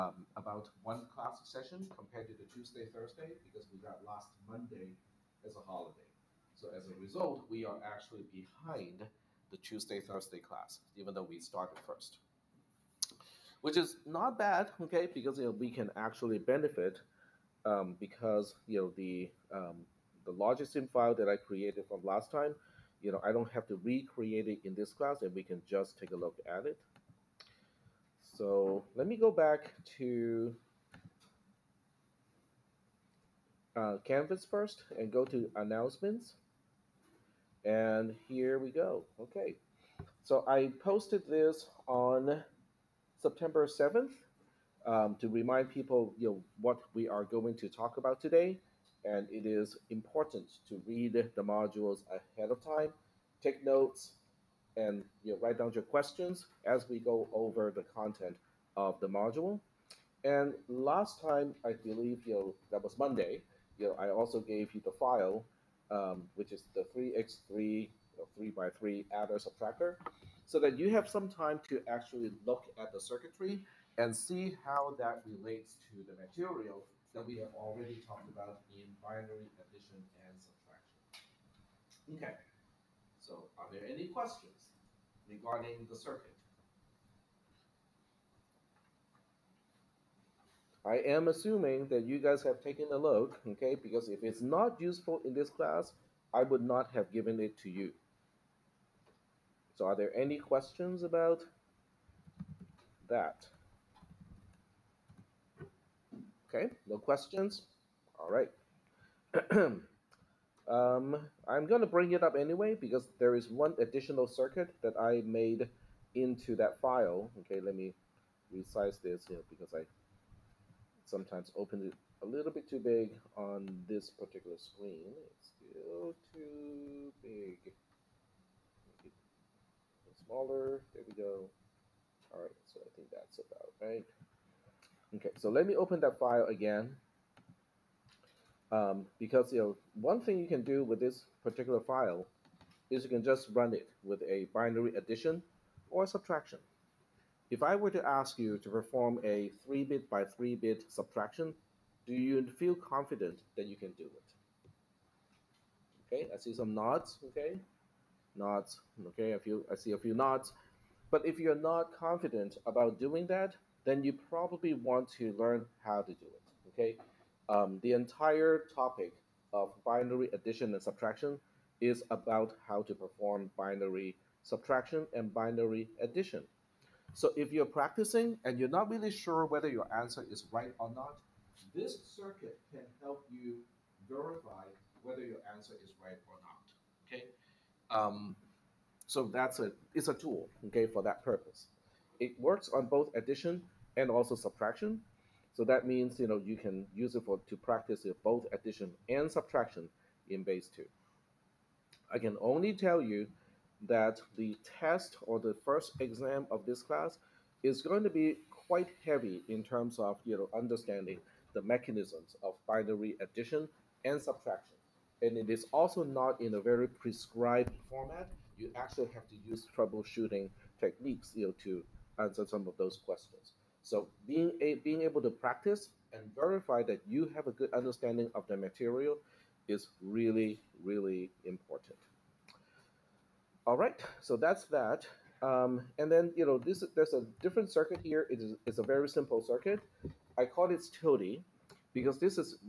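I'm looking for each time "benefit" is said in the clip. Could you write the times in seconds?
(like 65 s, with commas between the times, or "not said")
16 s.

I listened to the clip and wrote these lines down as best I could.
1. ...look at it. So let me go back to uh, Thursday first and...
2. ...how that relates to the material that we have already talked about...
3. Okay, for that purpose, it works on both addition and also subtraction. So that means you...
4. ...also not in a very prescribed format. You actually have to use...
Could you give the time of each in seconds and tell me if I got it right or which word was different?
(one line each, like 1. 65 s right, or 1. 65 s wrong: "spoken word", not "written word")
1. 26 s wrong: "Canvas", not "Thursday"
2. 74 s right
3. 190 s right
4. 215 s right.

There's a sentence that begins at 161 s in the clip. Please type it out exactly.
But if you're not confident about doing that, then you probably want to learn how to do it, okay?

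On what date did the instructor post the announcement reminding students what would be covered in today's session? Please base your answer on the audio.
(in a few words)
September 7th.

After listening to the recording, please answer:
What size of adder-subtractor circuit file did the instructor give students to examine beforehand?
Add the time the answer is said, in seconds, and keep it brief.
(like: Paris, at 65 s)
3x3, at 66 s.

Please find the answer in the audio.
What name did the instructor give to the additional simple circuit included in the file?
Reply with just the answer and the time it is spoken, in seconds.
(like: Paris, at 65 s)
TILDE, at 240 s.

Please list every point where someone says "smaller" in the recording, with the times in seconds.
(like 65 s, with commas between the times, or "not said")
130 s.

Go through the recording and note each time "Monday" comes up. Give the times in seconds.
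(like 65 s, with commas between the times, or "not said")
4 s, 62 s.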